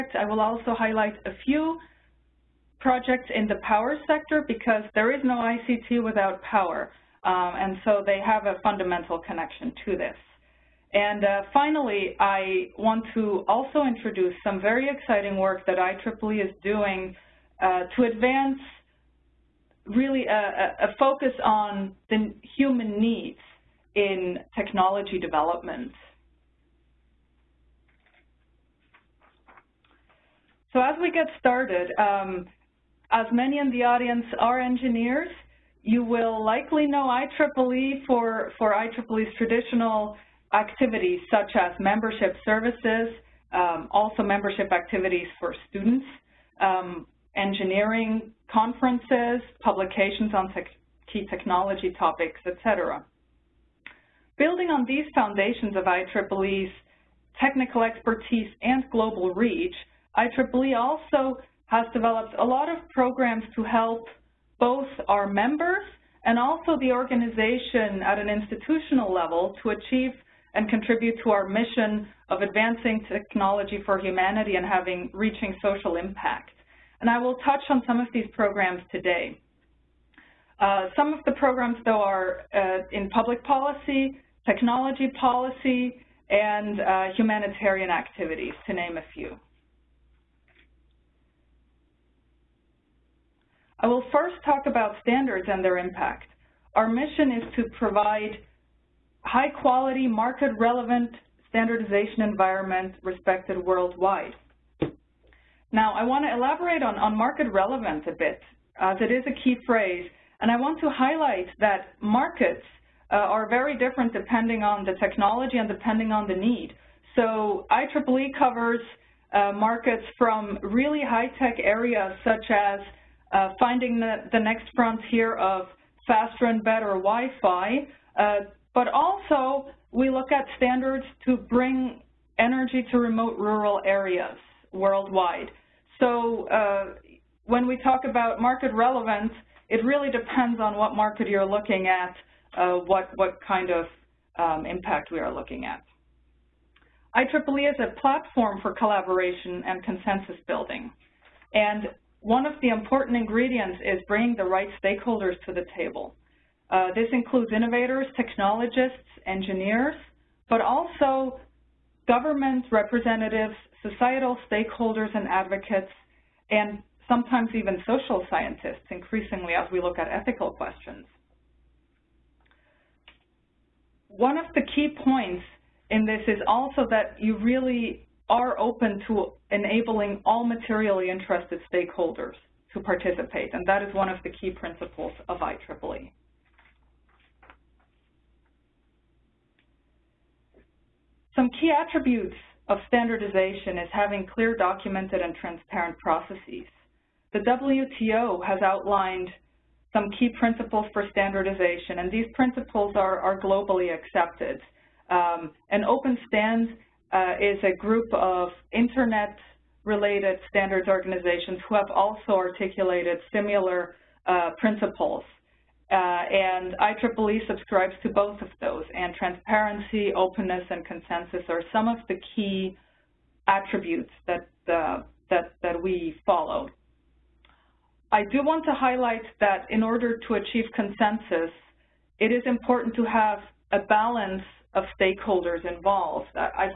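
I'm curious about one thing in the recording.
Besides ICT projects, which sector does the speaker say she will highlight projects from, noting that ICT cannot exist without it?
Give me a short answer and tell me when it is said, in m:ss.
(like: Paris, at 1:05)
Power sector, at 0:03.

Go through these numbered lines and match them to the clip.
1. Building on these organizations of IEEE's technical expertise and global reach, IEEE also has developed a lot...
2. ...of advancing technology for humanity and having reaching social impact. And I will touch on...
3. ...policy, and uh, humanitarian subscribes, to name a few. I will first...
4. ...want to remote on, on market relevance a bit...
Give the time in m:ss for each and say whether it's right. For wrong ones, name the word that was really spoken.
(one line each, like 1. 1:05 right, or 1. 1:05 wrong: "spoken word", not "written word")
1. 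0:54 wrong: "foundations", not "organizations"
2. 1:12 right
3. 1:25 wrong: "activities", not "subscribes"
4. 1:46 wrong: "elaborate", not "remote".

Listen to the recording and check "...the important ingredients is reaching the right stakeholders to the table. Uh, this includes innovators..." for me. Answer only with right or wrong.
wrong.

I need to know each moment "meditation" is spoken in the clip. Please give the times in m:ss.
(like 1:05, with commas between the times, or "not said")
not said.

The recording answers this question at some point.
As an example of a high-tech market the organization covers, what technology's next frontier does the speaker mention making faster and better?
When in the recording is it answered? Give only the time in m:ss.
2:06.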